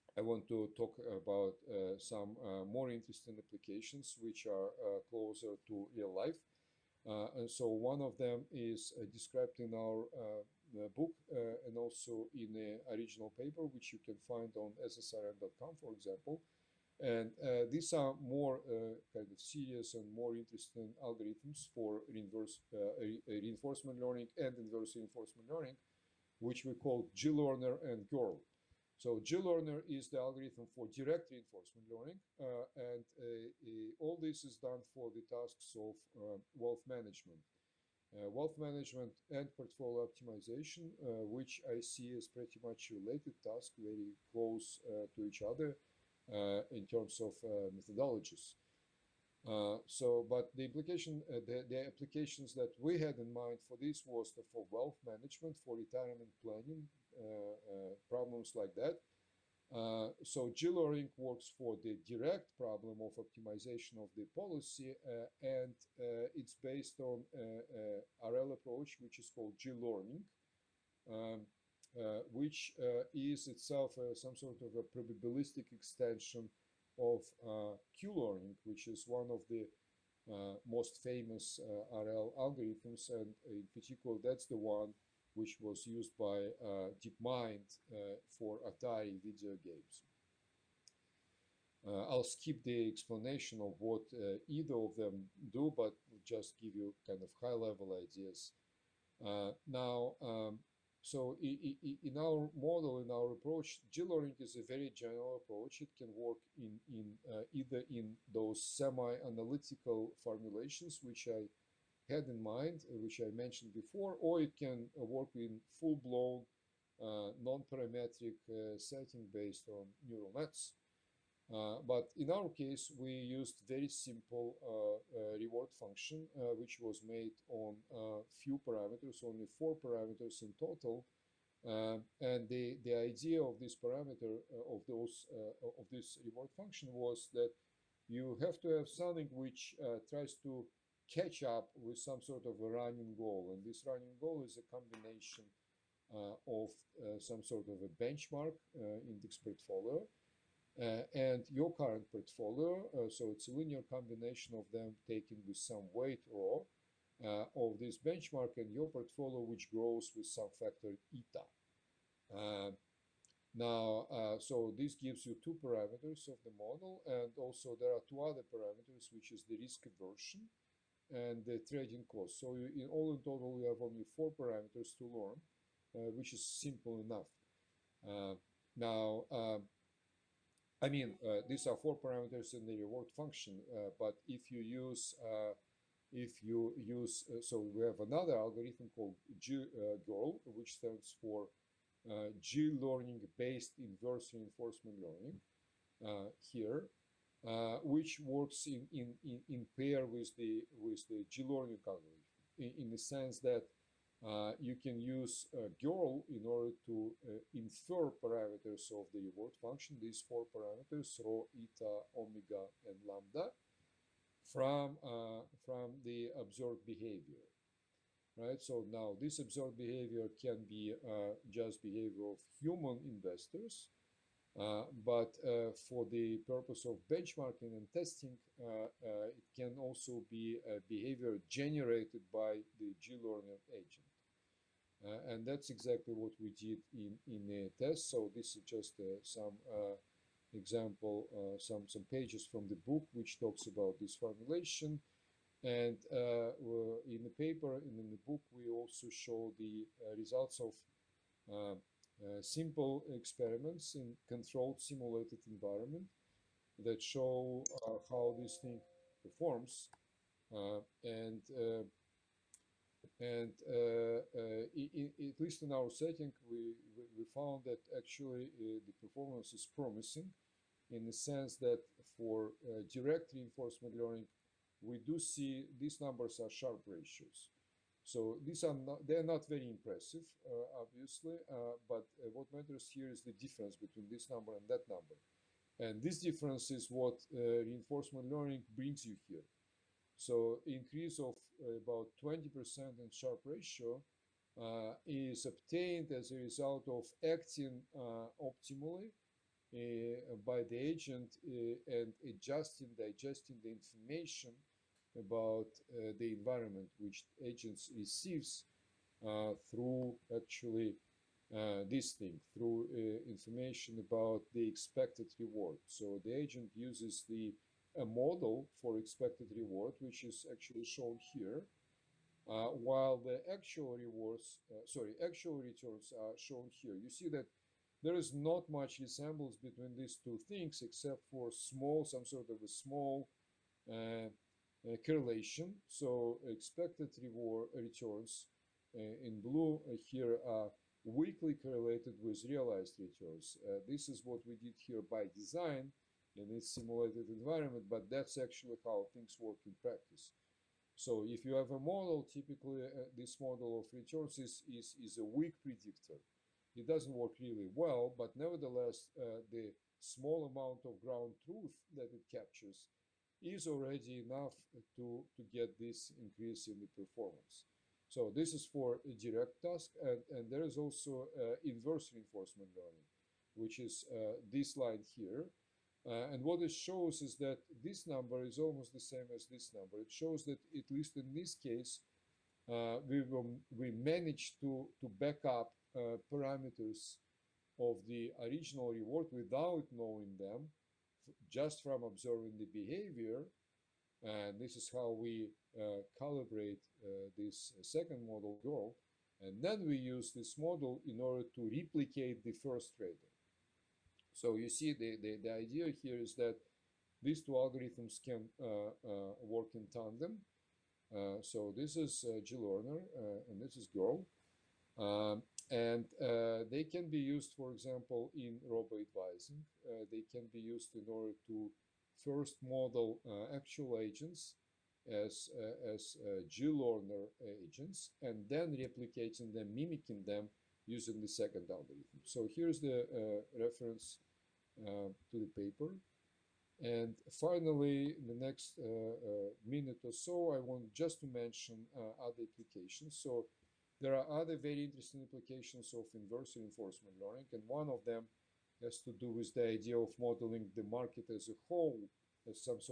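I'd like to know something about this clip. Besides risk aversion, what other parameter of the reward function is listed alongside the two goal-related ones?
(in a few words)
trading cost.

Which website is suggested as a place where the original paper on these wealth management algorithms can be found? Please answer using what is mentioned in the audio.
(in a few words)
ssrn.com.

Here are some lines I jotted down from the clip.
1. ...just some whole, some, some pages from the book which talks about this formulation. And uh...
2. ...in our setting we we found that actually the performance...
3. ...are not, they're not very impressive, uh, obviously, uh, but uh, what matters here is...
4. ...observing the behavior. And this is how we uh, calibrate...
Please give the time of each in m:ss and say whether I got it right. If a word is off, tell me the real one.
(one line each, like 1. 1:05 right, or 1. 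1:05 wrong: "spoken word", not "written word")
1. 3:58 wrong: "example", not "whole"
2. 4:25 right
3. 4:38 right
4. 6:32 right.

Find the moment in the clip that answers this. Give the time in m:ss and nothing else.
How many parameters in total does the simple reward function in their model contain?
2:09.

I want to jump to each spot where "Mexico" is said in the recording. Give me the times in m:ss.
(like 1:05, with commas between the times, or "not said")
not said.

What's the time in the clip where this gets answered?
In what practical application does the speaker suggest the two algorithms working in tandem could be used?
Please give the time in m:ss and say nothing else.
6:58.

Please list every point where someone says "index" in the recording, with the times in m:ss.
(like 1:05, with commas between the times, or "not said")
2:29.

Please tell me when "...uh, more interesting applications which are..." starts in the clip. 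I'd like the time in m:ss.
0:02.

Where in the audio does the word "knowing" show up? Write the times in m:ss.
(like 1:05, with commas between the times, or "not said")
6:29.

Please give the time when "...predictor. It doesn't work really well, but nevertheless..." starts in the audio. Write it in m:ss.
5:55.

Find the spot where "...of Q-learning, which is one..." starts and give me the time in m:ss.
1:16.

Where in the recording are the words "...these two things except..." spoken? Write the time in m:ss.
5:29.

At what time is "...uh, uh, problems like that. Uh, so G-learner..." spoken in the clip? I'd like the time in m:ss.
0:57.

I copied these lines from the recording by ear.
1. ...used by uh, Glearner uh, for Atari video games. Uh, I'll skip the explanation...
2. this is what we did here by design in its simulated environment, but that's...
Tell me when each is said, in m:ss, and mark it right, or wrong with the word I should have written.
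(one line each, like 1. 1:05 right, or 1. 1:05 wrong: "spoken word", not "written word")
1. 1:25 wrong: "DeepMind", not "Glearner"
2. 5:43 right.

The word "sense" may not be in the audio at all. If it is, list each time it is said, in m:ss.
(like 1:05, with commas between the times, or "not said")
3:22, 4:31.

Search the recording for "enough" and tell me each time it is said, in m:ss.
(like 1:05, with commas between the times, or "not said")
2:57, 6:04.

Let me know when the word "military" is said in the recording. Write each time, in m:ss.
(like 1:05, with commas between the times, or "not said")
not said.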